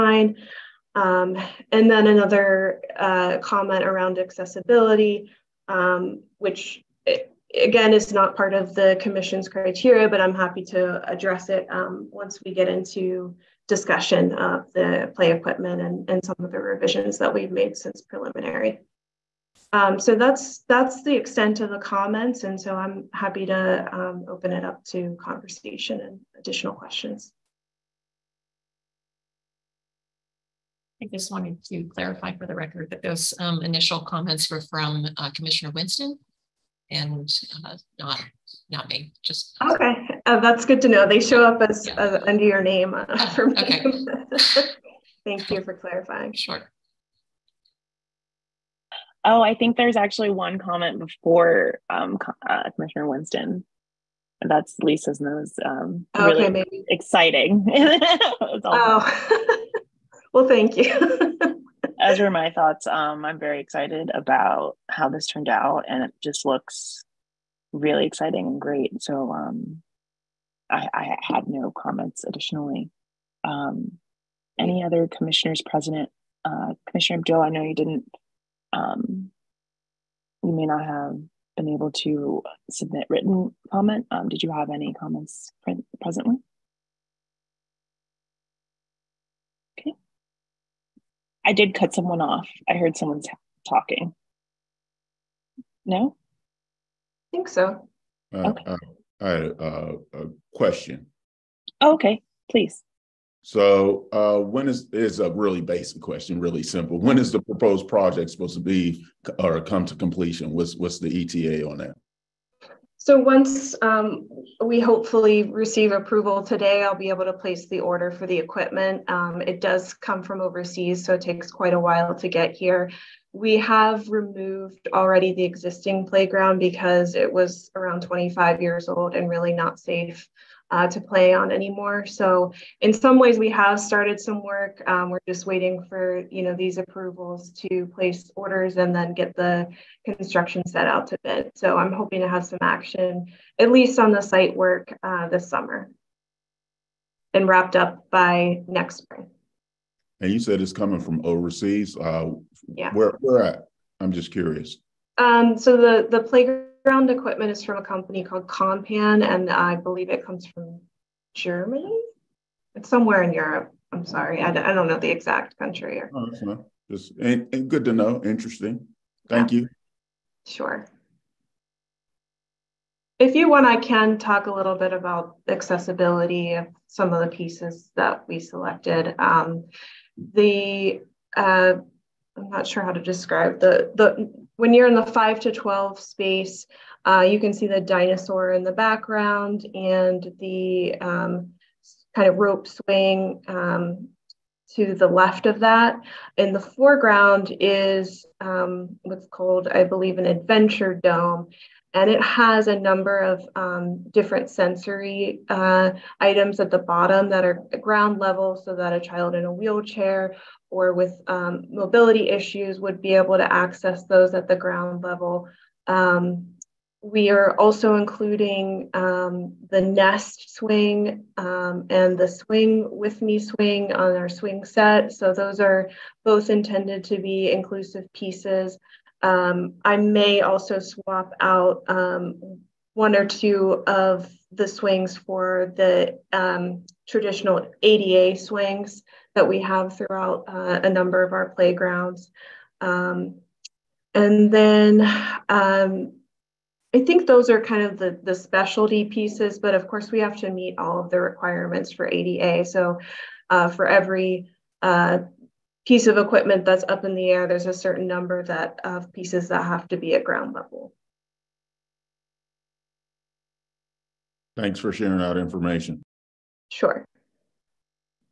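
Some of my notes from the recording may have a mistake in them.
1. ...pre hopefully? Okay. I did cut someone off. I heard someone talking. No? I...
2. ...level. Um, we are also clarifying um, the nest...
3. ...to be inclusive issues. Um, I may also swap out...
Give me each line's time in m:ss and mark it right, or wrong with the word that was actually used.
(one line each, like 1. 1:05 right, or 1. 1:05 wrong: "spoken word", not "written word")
1. 1:25 wrong: "presently", not "hopefully"
2. 3:35 wrong: "including", not "clarifying"
3. 3:47 wrong: "pieces", not "issues".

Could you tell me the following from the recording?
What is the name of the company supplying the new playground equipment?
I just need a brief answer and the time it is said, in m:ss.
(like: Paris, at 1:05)
Kompan, at 2:38.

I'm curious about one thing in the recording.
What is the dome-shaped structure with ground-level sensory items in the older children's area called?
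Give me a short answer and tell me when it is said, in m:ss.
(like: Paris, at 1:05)
adventure dome, at 3:20.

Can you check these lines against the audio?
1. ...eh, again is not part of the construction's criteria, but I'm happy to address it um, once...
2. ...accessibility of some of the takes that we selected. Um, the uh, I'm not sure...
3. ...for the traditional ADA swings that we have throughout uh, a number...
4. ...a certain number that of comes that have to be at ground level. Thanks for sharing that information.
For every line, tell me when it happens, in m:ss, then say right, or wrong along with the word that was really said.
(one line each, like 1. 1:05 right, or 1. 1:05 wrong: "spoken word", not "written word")
1. 0:07 wrong: "commission", not "construction"
2. 2:55 wrong: "pieces", not "takes"
3. 3:55 right
4. 4:17 wrong: "pieces", not "comes".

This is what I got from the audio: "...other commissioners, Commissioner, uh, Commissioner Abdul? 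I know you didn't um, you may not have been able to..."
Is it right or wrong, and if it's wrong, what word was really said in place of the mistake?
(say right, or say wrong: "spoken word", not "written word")
wrong: "President", not "Commissioner".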